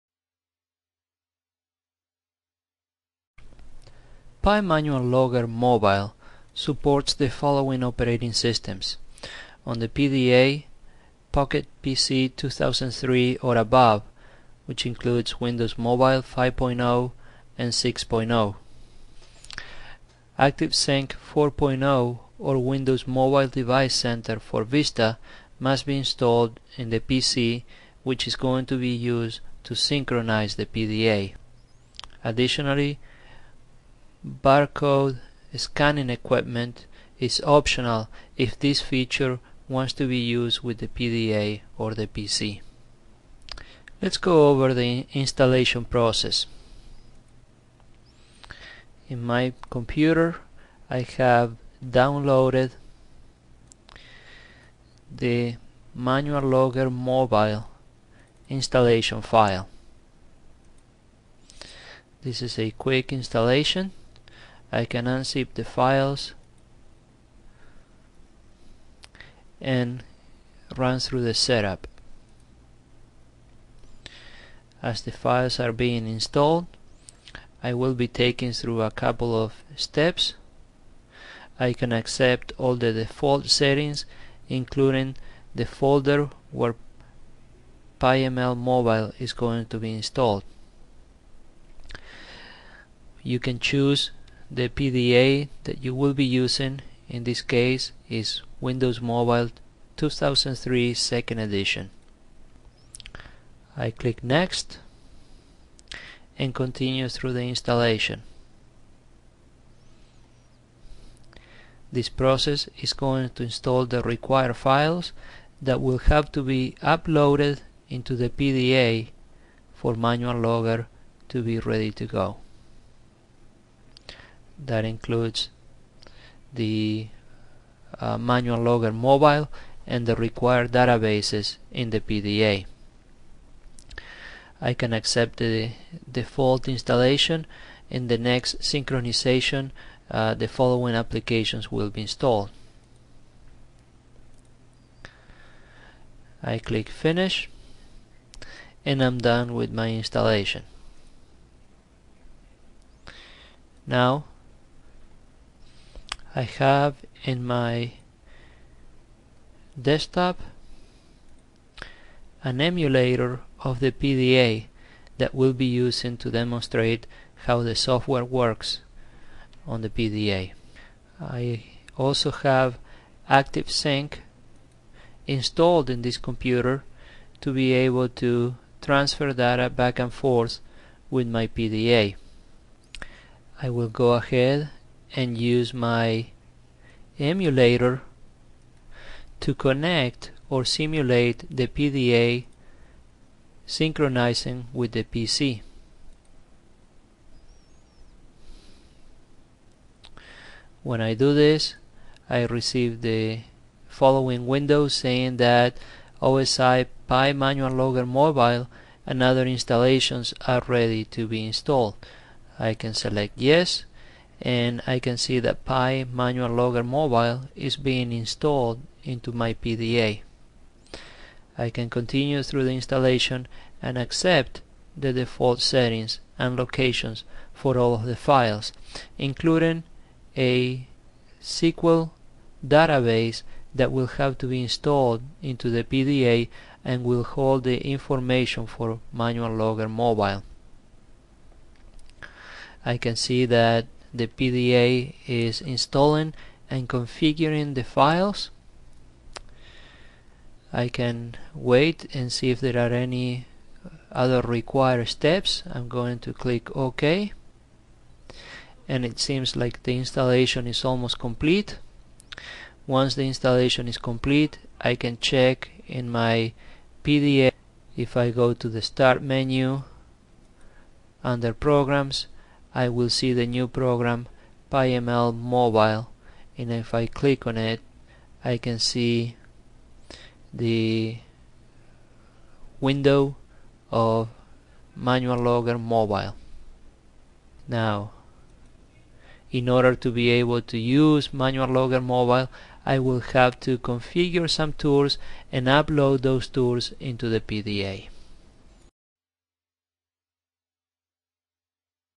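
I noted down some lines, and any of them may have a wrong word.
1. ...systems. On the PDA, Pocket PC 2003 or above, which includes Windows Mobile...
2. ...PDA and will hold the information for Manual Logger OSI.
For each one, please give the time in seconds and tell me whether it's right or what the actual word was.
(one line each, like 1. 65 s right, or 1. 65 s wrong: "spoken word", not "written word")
1. 8 s right
2. 235 s wrong: "Mobile", not "OSI".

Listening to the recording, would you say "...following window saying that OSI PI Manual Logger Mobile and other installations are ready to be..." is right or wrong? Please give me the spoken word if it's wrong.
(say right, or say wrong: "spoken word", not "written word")
right.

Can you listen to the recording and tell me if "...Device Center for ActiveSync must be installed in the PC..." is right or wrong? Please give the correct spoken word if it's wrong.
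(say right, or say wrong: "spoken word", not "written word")
wrong: "Vista", not "ActiveSync".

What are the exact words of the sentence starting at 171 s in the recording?
I also have ActiveSync installed in this computer to be able to transfer data back and forth with my PDA.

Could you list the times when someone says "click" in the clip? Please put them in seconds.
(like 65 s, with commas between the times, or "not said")
103 s, 146 s, 256 s, 277 s.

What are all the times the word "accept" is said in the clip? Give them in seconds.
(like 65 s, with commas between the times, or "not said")
81 s, 134 s, 223 s.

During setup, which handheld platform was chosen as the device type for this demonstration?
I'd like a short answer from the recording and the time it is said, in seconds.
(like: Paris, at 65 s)
Windows Mobile 2003 second edition, at 98 s.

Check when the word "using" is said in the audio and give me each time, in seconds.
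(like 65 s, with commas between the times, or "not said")
96 s, 165 s.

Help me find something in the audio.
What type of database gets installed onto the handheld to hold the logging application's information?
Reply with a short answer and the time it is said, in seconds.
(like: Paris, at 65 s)
SQL database, at 231 s.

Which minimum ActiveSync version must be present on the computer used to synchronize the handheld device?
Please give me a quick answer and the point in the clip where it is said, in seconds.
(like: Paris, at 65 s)
ActiveSync 4.0, at 20 s.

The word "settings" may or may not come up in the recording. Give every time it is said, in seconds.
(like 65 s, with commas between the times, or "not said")
83 s, 225 s.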